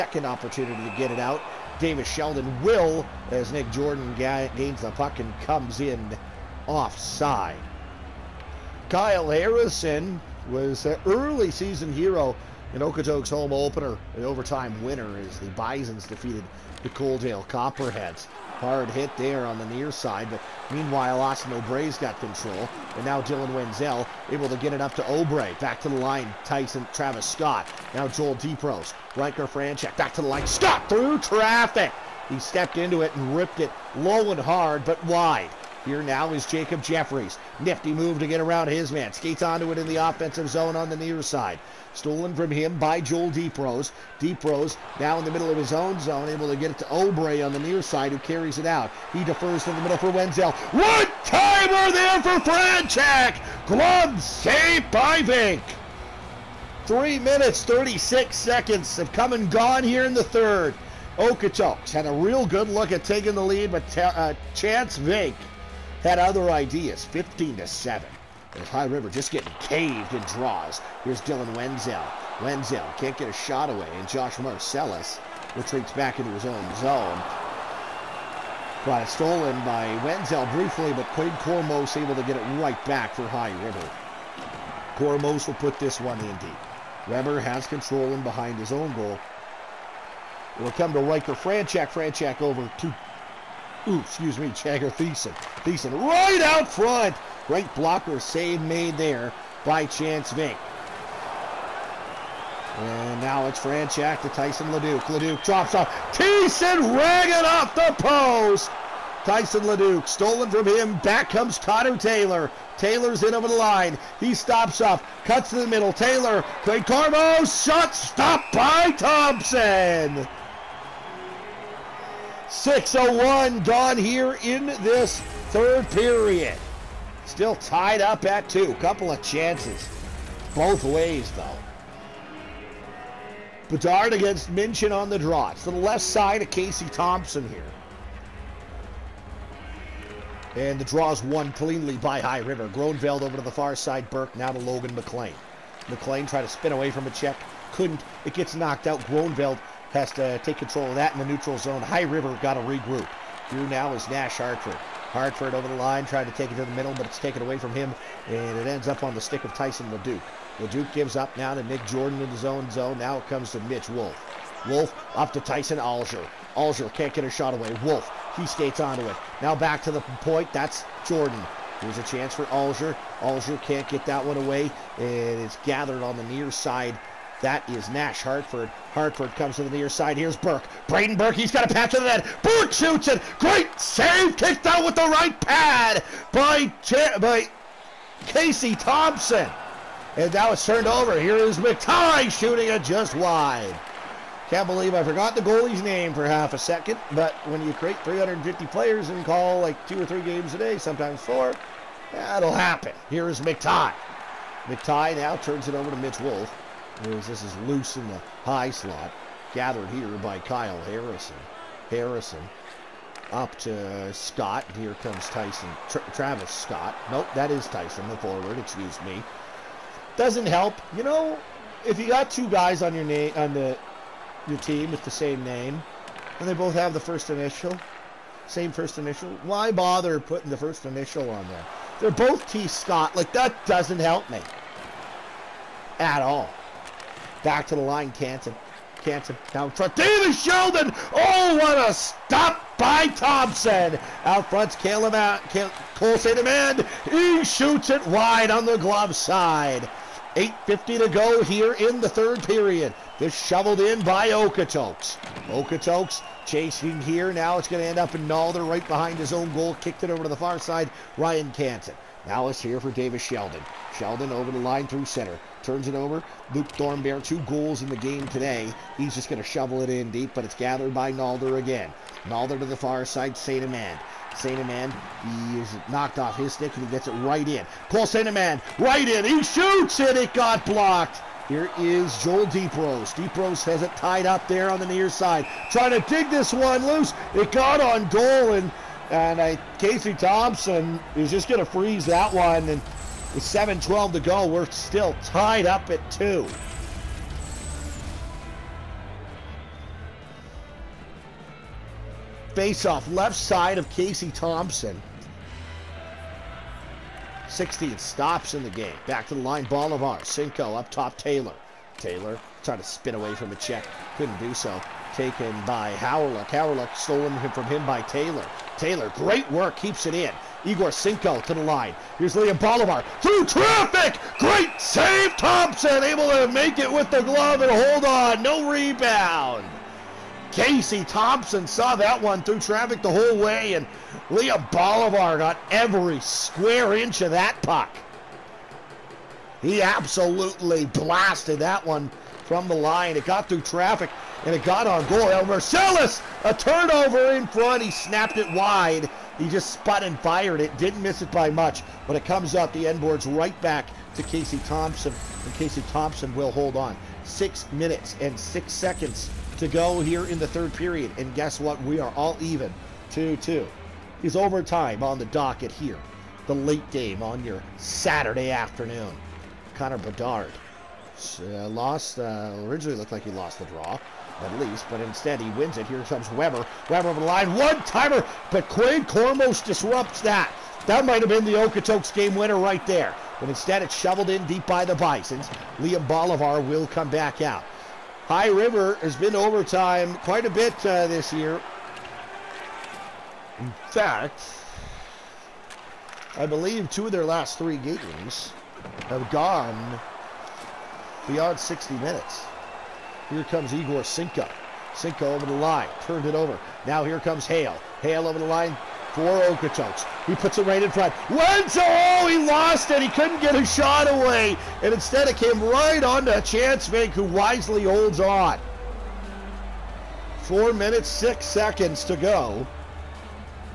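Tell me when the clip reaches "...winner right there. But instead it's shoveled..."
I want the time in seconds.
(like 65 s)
382 s.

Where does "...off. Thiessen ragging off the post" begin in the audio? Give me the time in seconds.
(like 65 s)
105 s.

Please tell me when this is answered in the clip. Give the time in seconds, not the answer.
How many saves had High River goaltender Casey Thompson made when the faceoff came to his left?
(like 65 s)
307 s.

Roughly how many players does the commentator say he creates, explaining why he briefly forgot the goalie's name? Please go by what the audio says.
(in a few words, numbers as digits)
350.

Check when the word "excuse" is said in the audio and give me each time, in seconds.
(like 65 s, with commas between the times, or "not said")
93 s, 218 s.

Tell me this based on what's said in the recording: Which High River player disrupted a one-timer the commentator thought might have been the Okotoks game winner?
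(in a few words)
Quinn Cormos.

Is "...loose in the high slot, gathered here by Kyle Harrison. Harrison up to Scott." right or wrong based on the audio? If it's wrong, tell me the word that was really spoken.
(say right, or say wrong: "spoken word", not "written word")
right.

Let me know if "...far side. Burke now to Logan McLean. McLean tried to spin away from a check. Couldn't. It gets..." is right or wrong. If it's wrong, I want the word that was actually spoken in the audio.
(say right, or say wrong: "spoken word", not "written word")
right.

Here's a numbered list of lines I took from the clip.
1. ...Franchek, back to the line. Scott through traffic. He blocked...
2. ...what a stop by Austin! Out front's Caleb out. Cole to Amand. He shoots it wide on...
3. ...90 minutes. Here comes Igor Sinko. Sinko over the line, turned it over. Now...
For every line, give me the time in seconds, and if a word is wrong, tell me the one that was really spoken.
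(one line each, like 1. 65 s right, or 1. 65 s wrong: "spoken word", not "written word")
1. 29 s wrong: "stepped", not "blocked"
2. 241 s wrong: "Thompson", not "Austin"
3. 401 s wrong: "60", not "90".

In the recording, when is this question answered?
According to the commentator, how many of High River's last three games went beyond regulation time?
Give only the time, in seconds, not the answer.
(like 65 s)
396 s.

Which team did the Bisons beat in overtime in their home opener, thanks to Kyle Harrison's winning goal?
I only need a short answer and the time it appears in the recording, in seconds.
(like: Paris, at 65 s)
Coaldale Copperheads, at 16 s.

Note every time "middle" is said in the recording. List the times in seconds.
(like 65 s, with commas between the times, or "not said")
45 s, 49 s, 115 s, 156 s.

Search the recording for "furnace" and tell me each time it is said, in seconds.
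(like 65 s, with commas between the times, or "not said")
not said.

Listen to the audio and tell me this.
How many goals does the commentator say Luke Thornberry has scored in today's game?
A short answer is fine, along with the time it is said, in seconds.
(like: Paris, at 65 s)
2, at 267 s.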